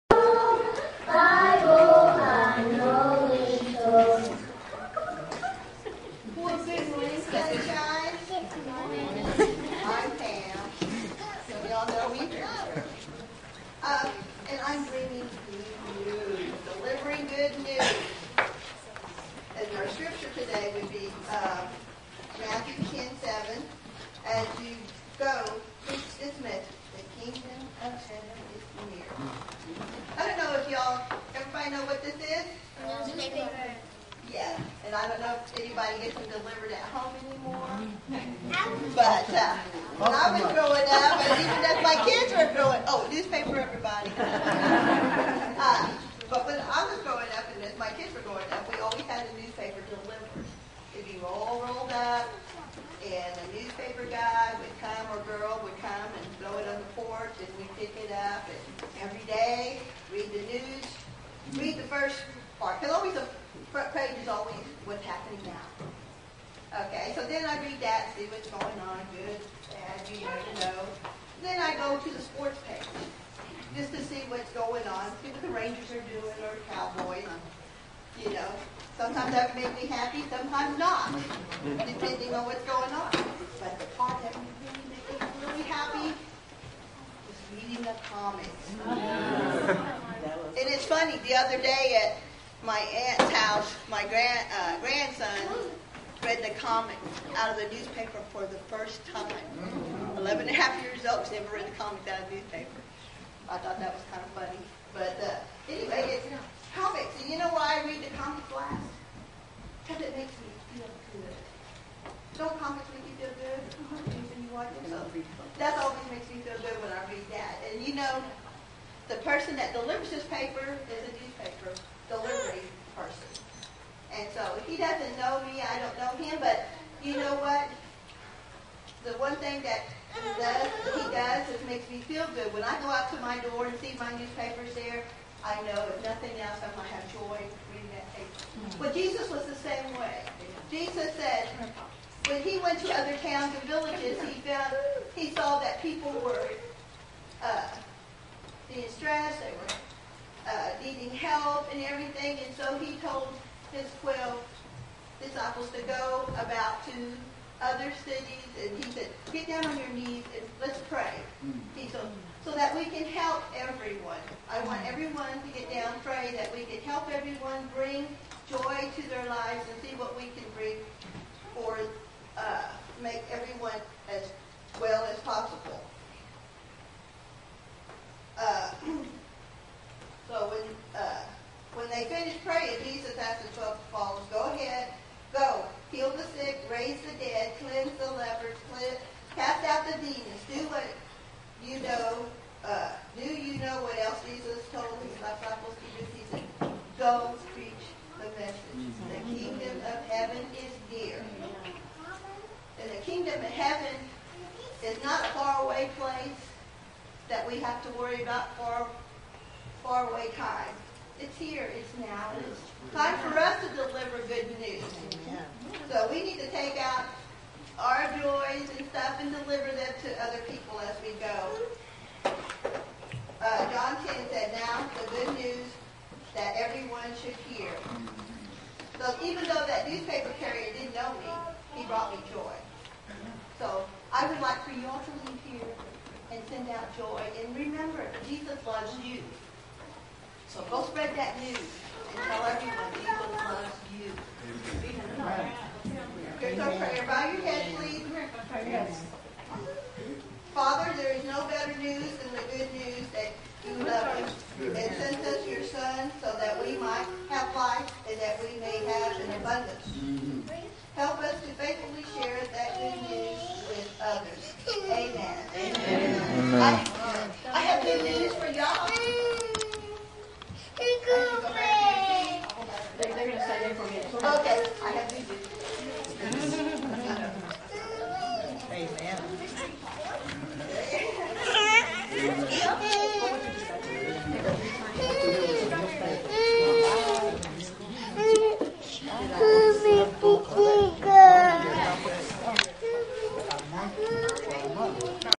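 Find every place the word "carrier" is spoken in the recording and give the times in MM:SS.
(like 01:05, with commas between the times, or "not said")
03:50.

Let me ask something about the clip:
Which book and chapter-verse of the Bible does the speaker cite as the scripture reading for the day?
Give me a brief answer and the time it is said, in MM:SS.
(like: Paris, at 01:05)
Matthew 10:7, at 00:22.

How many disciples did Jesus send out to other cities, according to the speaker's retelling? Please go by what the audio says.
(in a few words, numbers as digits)
12.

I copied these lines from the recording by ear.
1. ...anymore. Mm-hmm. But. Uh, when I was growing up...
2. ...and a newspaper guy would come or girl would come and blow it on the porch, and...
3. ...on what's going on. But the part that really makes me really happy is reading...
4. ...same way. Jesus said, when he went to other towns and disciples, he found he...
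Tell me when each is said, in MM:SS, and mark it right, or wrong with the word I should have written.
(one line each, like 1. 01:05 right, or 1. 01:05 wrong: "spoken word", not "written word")
1. 00:37 right
2. 00:53 right
3. 01:22 right
4. 02:19 wrong: "villages", not "disciples".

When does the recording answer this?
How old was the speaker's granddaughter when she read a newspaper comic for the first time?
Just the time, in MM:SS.
01:40.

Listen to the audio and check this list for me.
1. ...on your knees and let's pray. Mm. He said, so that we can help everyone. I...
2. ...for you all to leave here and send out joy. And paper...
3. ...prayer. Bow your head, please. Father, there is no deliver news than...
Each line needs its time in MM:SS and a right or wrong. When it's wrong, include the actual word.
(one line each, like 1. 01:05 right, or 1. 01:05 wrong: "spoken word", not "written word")
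1. 02:39 right
2. 03:54 wrong: "remember", not "paper"
3. 04:06 wrong: "better", not "deliver".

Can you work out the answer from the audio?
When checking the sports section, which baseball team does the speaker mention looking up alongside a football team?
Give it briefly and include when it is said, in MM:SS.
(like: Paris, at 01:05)
Rangers, at 01:15.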